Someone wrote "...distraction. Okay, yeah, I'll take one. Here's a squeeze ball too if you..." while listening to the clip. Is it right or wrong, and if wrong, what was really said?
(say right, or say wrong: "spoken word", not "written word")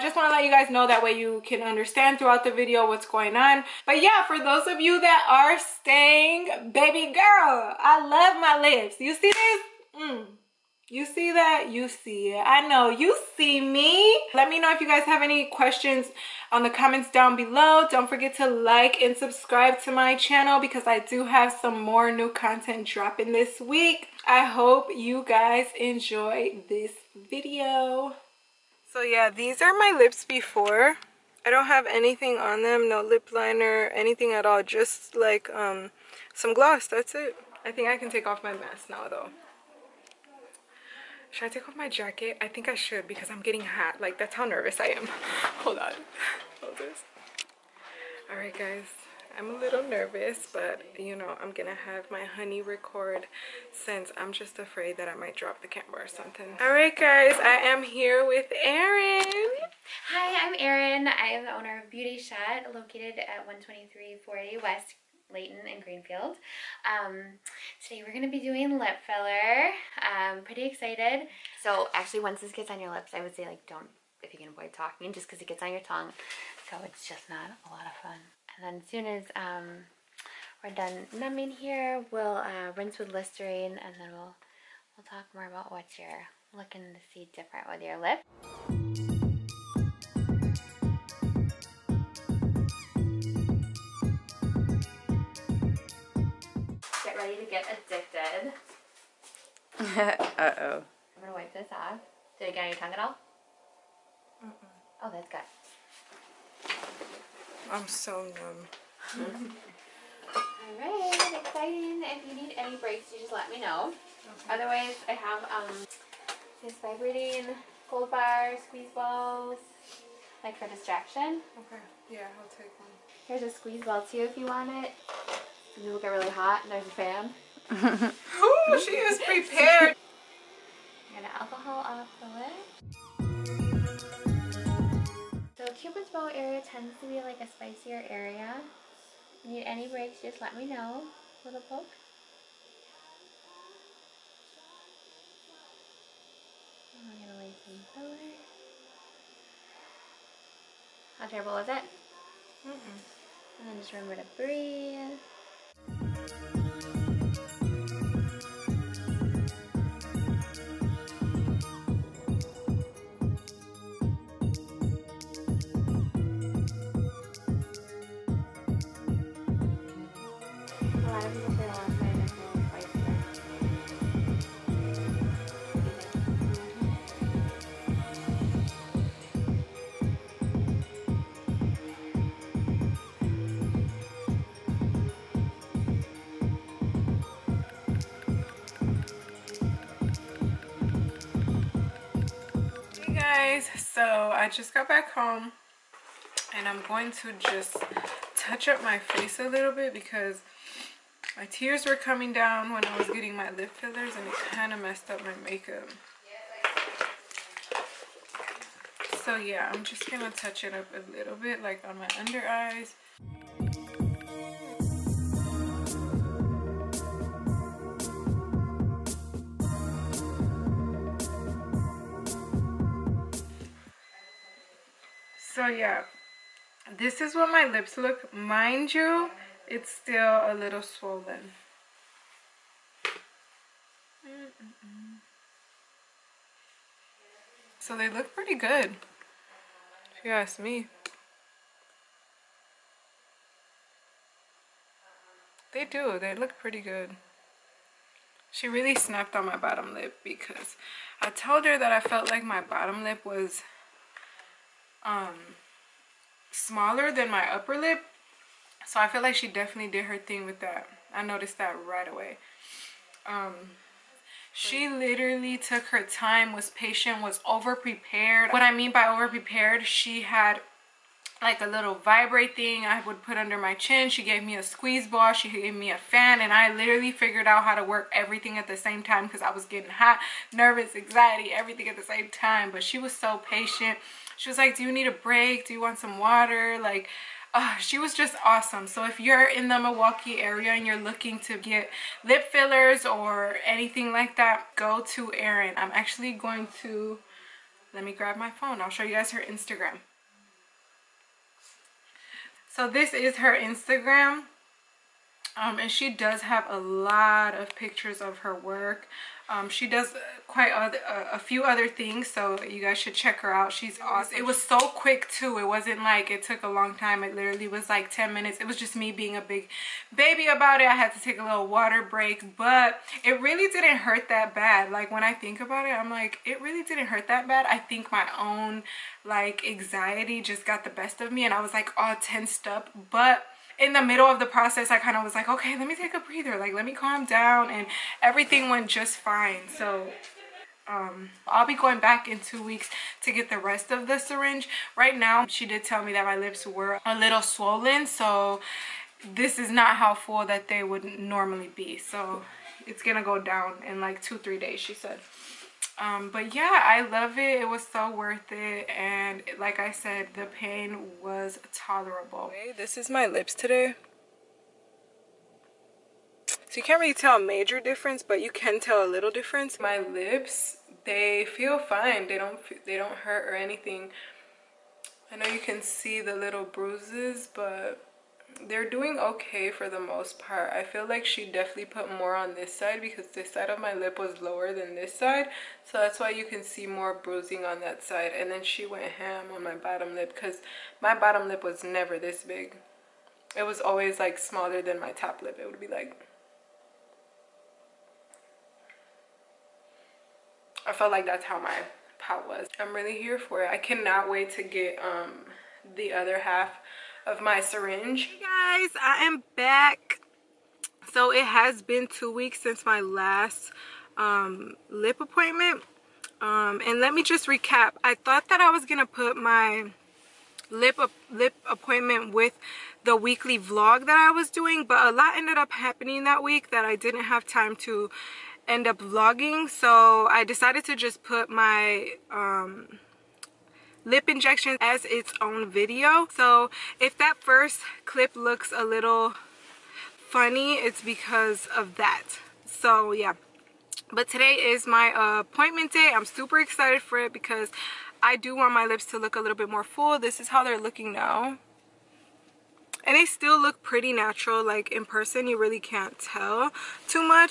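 right.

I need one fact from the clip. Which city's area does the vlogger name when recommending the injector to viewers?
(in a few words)
Milwaukee.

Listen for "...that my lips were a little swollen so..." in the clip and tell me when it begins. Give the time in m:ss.
5:46.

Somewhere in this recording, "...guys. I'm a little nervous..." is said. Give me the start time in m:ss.
0:48.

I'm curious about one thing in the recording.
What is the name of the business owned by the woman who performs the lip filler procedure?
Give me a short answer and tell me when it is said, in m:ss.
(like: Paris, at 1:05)
Beauty Shot, at 1:01.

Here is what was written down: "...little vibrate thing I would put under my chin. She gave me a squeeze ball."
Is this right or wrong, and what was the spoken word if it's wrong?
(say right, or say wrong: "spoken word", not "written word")
right.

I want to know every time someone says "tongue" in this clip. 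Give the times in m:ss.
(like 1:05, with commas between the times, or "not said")
1:15, 1:42.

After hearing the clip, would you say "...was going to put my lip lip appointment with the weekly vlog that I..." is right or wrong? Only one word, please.
right.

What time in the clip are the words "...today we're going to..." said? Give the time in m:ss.
1:07.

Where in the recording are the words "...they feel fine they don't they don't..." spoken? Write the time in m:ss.
6:11.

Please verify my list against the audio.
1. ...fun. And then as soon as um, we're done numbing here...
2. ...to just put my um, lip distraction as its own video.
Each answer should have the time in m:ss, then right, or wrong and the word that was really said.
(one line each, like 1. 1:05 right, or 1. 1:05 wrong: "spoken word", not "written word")
1. 1:18 right
2. 7:10 wrong: "injection", not "distraction".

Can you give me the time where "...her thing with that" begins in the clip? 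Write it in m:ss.
4:20.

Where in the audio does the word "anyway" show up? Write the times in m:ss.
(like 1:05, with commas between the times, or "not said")
not said.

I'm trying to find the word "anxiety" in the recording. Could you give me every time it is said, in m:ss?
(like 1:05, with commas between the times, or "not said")
4:40, 5:29.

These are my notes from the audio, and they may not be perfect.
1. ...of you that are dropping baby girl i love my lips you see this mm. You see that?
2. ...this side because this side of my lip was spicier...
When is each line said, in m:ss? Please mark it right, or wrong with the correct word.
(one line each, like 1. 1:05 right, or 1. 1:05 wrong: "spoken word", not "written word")
1. 0:04 wrong: "staying", not "dropping"
2. 6:22 wrong: "lower", not "spicier".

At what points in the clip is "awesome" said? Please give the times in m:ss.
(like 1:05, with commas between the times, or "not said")
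4:48, 5:14.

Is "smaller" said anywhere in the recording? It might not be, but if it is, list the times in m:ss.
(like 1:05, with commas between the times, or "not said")
4:16, 6:34.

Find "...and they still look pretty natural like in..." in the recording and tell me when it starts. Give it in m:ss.
7:33.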